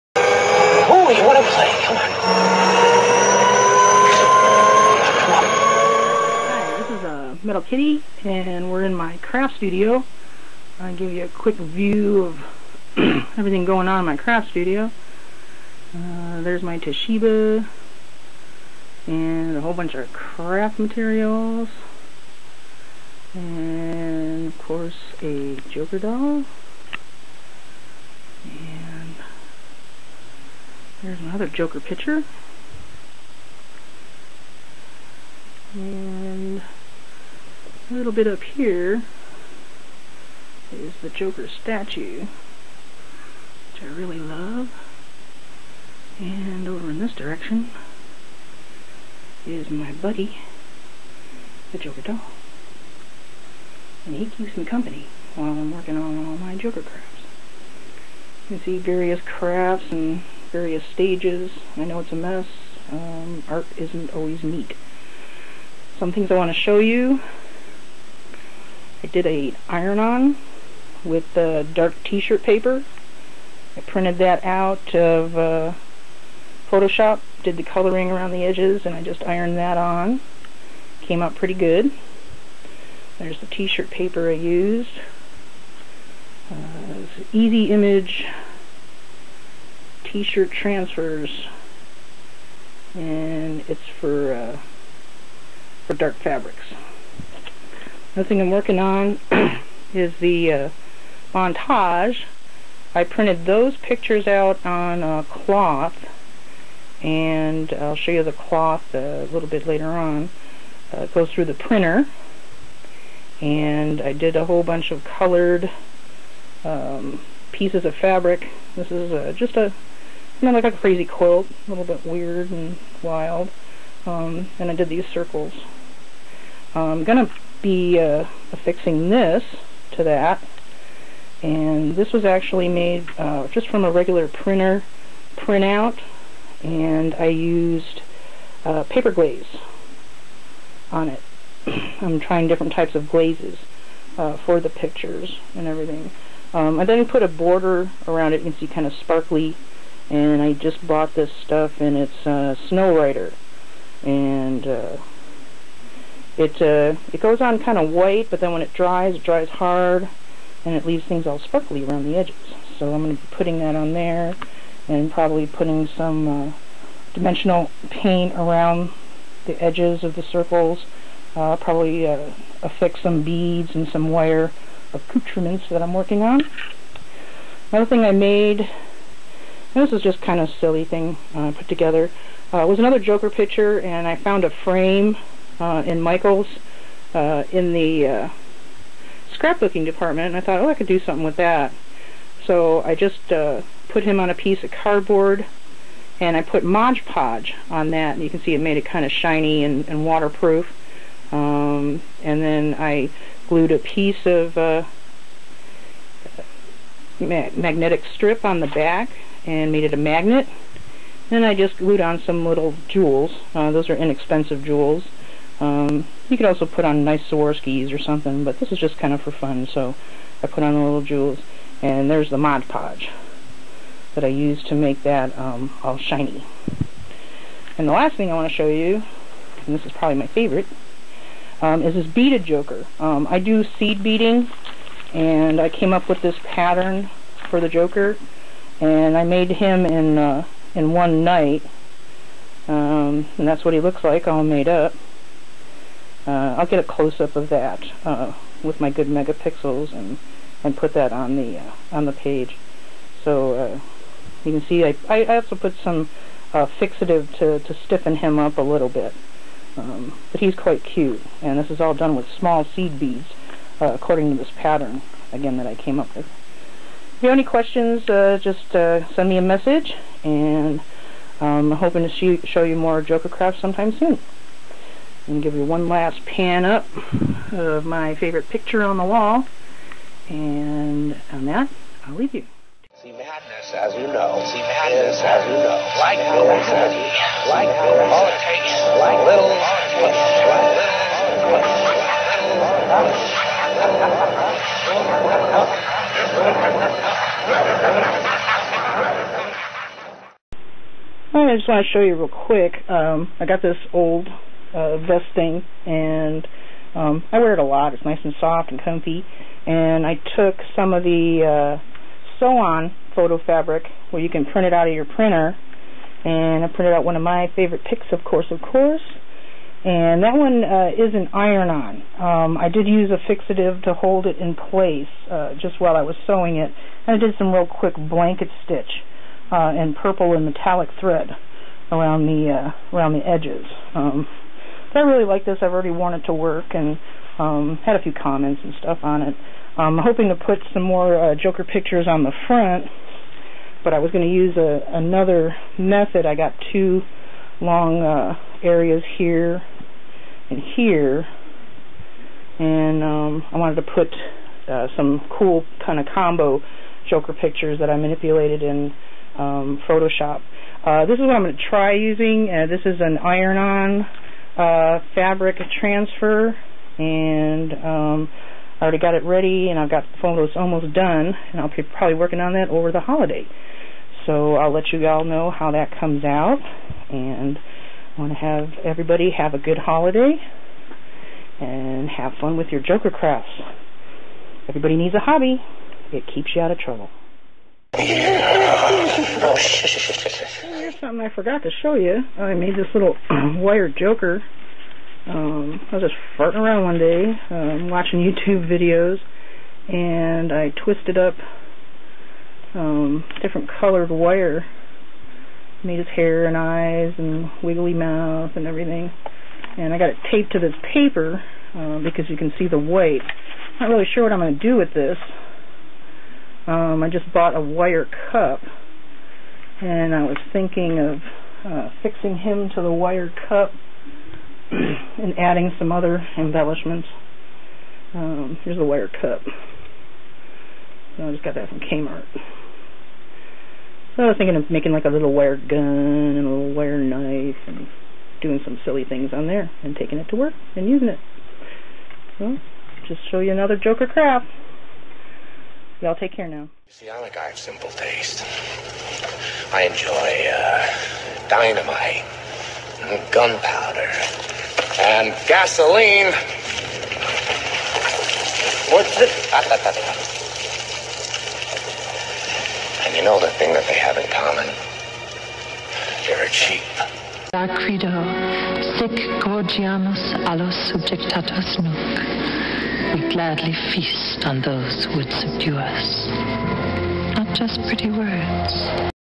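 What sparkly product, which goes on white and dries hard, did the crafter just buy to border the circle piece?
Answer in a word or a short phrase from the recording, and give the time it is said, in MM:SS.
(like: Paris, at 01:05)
Snow-Writer, at 02:32.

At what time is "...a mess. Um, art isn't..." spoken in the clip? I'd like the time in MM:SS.
01:02.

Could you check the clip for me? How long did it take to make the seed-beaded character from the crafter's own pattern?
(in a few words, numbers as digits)
one night.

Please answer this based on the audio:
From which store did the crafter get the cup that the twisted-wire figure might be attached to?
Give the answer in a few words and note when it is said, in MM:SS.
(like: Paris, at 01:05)
Kmart, at 07:11.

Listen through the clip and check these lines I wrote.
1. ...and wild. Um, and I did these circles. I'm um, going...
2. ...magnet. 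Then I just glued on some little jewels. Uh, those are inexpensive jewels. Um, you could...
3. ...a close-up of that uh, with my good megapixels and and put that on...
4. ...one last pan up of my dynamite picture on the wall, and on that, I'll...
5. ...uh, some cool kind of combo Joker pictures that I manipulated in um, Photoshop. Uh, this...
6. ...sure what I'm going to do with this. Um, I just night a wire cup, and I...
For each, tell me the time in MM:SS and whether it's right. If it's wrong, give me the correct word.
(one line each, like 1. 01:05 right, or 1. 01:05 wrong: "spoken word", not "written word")
1. 02:02 right
2. 03:29 right
3. 04:06 right
4. 04:35 wrong: "favorite", not "dynamite"
5. 05:54 right
6. 06:54 wrong: "bought", not "night".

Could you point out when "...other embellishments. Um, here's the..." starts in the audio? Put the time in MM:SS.
07:05.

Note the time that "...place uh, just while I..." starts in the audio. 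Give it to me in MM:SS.
05:24.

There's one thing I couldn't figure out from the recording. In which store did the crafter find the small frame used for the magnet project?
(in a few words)
Michael's.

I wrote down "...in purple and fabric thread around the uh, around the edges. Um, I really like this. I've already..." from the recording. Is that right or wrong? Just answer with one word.
wrong.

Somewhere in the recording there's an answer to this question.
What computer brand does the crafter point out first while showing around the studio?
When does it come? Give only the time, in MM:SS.
00:16.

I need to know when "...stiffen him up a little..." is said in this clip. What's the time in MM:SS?
04:17.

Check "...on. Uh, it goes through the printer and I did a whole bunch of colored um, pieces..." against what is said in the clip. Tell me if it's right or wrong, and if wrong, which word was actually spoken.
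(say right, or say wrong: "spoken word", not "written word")
right.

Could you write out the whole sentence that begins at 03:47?
And the last thing I want to show you, and this is probably my favorite, um, is this beaded joker.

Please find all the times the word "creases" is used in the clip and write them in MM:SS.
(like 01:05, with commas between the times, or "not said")
not said.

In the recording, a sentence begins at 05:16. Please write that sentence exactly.
And I printed out one of my favorite pics, of course, of course.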